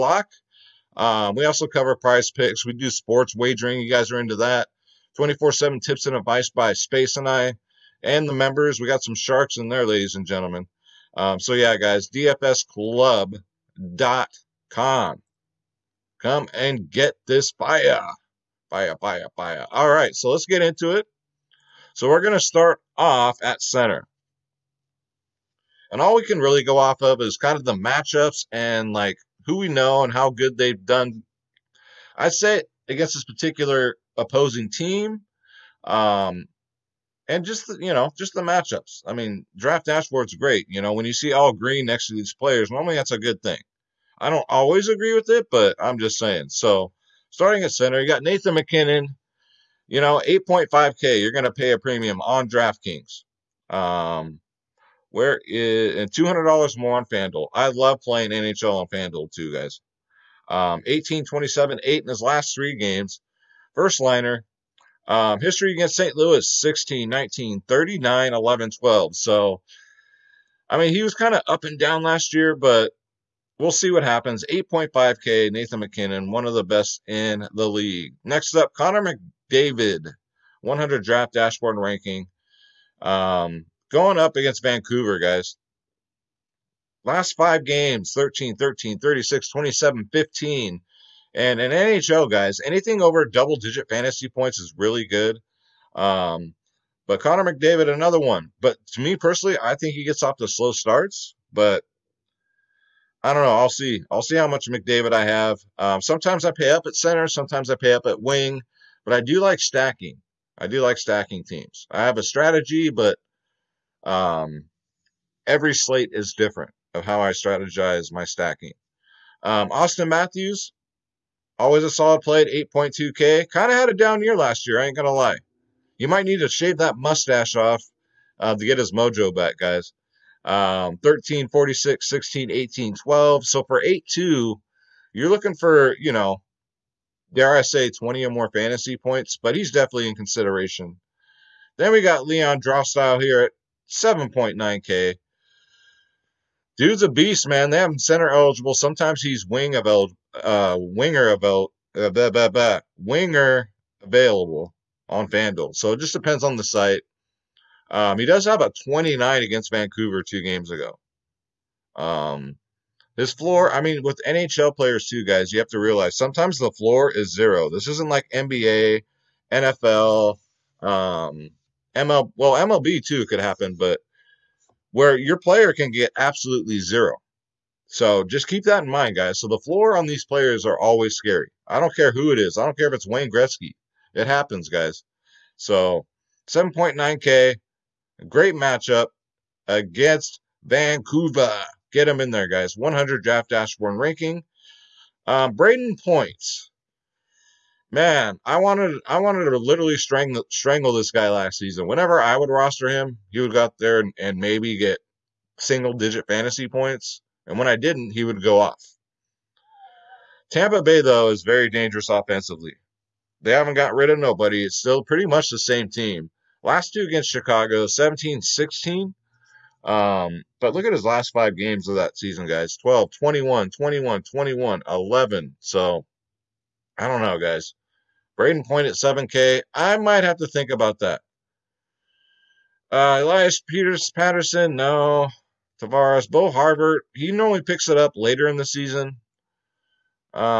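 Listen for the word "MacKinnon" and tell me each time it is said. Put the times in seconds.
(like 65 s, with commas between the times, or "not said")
48 s, 75 s.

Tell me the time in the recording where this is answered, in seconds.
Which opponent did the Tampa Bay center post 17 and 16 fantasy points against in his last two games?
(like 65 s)
217 s.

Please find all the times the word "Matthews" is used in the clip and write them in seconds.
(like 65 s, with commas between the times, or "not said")
120 s.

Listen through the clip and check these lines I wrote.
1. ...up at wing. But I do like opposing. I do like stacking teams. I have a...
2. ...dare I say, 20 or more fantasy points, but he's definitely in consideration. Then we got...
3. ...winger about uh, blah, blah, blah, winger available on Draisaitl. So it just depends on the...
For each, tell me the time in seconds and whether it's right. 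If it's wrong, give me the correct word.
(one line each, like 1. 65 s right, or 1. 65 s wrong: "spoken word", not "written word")
1. 107 s wrong: "stacking", not "opposing"
2. 137 s right
3. 150 s wrong: "FanDuel", not "Draisaitl".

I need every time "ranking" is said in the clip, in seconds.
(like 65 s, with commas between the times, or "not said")
81 s, 193 s.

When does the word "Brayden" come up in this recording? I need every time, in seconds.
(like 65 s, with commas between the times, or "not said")
195 s, 228 s.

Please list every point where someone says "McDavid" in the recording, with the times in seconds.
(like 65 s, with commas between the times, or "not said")
79 s, 97 s, 104 s.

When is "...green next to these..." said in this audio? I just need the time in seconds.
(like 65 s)
41 s.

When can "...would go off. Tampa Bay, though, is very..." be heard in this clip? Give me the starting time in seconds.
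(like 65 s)
208 s.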